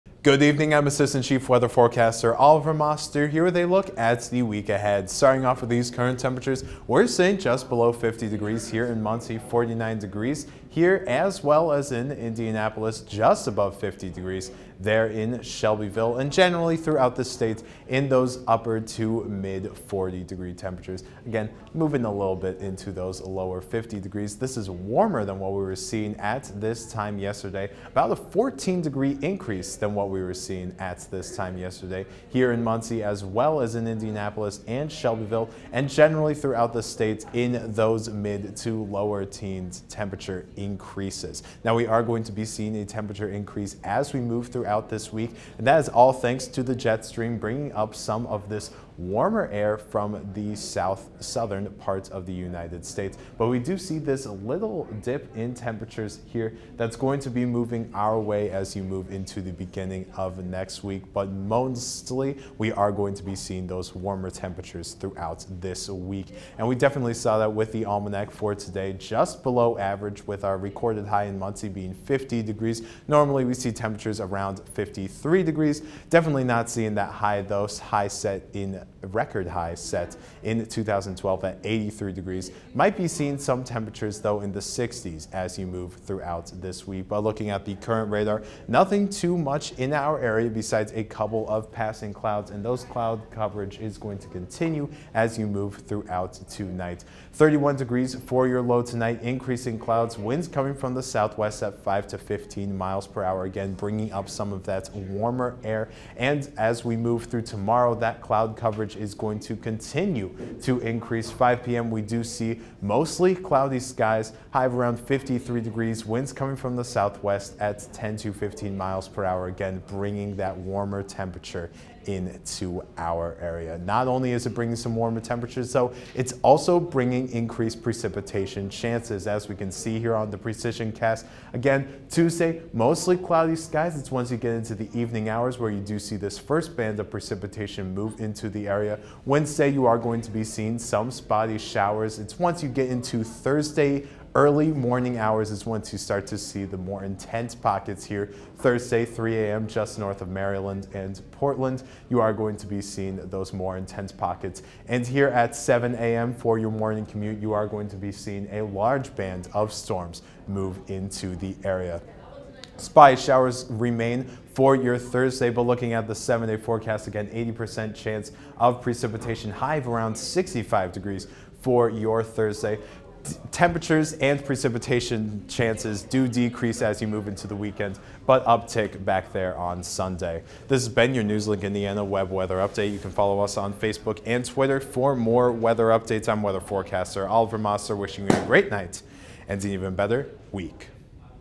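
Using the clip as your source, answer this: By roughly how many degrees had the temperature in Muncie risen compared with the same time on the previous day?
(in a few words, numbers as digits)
14 degrees.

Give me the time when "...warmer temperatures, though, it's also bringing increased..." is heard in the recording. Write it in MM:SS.
02:04.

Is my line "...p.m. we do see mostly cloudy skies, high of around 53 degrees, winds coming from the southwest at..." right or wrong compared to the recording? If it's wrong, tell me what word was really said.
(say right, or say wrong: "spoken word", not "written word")
right.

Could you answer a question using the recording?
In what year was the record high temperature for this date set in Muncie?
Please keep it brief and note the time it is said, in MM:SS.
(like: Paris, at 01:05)
2012, at 01:20.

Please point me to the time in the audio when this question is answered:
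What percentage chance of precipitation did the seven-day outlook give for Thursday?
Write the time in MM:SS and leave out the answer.
02:47.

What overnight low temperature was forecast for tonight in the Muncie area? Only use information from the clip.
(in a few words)
31 degrees.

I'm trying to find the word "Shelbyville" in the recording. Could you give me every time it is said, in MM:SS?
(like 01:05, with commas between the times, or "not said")
00:15, 00:34.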